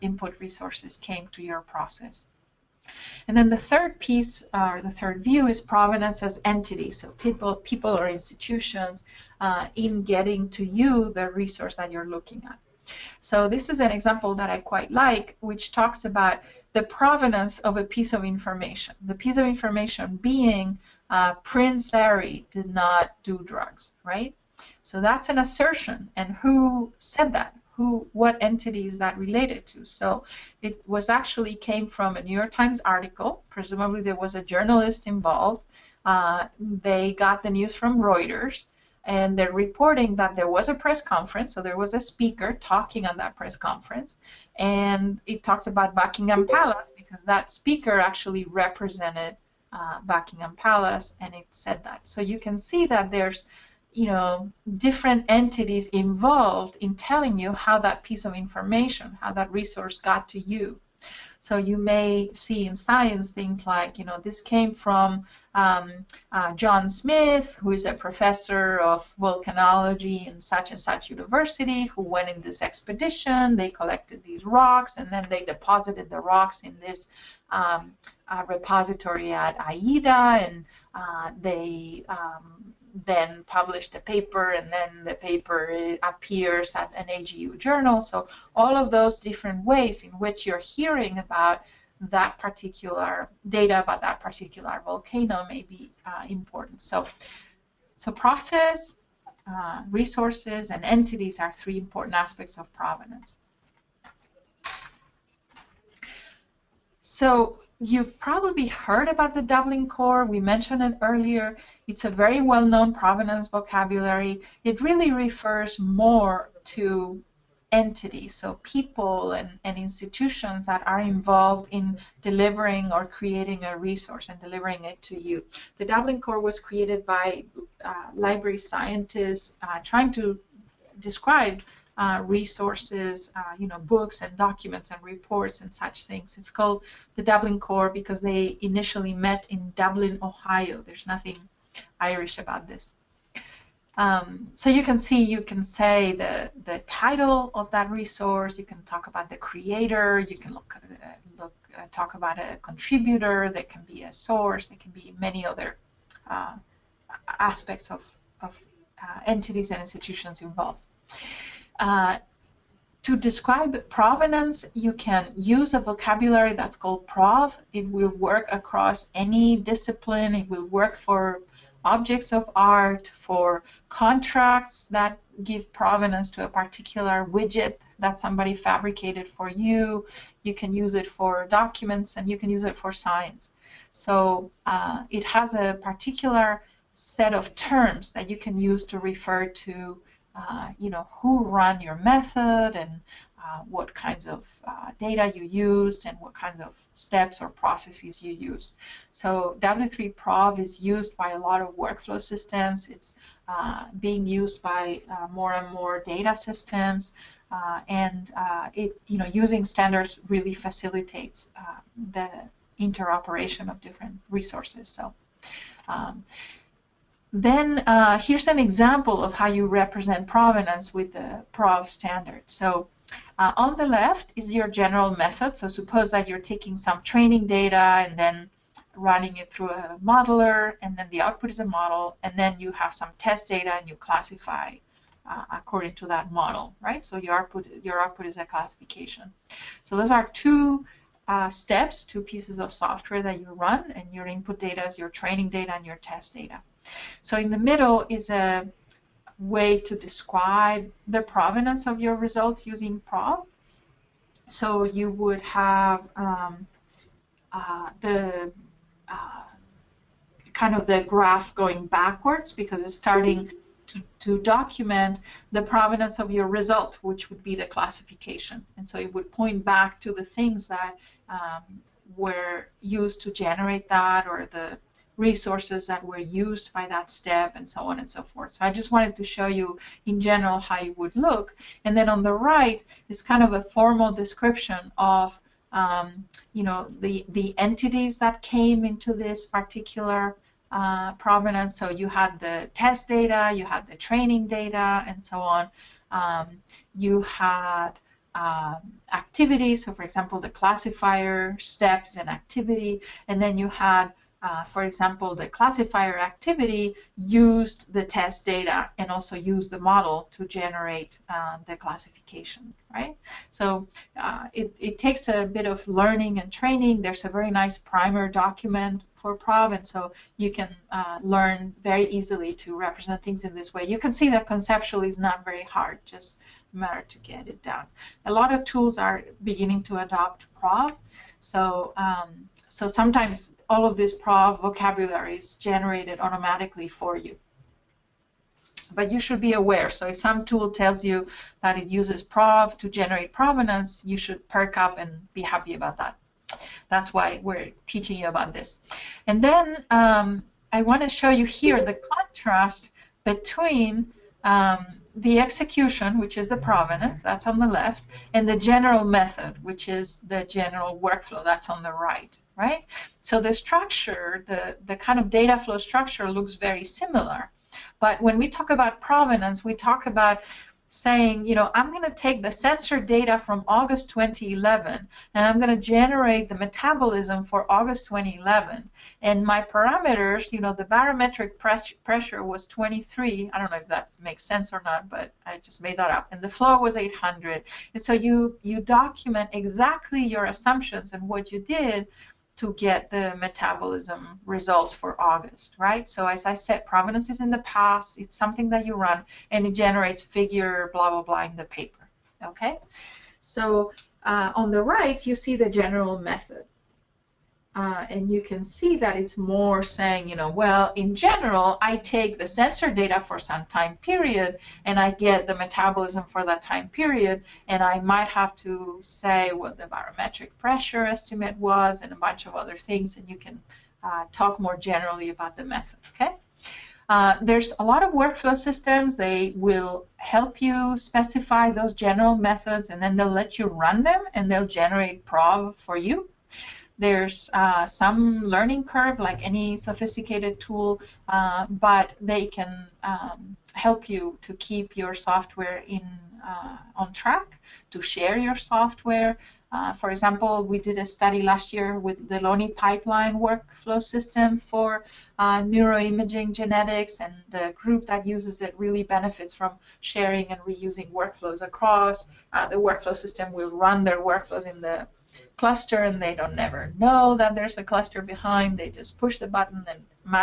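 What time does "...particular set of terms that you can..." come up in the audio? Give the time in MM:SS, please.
03:05.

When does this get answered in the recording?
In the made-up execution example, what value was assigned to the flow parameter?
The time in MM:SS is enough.
06:26.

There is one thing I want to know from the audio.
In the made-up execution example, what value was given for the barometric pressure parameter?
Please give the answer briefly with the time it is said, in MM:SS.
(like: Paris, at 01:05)
23, at 06:22.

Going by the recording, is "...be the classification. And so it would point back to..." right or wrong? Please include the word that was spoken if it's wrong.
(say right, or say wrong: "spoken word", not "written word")
right.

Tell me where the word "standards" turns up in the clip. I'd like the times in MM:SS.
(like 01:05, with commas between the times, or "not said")
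03:29, 03:41.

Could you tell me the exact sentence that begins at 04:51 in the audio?
So you had the test data, you had the training data, and so on.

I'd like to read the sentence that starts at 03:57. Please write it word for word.
So your output, your output is a classification.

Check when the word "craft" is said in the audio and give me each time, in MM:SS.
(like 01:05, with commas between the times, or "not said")
not said.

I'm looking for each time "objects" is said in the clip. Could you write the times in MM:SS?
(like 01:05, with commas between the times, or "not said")
02:51.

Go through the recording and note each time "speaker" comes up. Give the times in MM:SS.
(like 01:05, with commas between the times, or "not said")
00:42, 00:47.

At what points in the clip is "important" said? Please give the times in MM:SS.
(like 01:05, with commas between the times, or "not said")
01:36, 01:41.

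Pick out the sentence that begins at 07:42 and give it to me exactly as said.
the workflow system will run their workflows in the cluster and they don't never know that there's a cluster behind.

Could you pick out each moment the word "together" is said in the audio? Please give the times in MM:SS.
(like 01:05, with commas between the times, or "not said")
not said.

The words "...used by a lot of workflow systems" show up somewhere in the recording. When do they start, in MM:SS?
03:20.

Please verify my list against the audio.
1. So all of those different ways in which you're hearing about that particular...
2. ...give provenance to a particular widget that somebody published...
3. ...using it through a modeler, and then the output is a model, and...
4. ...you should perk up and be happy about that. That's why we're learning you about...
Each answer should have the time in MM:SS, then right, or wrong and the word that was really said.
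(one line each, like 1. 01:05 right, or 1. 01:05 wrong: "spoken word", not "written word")
1. 01:28 right
2. 02:55 wrong: "fabricated", not "published"
3. 03:48 wrong: "running", not "using"
4. 05:44 wrong: "teaching", not "learning".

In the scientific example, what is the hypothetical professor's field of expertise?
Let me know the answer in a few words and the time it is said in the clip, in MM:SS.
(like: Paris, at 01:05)
volcanology, at 01:09.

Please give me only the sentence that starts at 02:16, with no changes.
It's called the Dublin Core because they initially met in Dublin, Ohio.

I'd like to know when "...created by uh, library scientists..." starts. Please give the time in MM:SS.
02:06.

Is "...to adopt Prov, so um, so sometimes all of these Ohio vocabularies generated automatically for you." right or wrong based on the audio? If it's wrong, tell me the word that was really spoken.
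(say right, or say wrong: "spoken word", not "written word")
wrong: "PROV", not "Ohio".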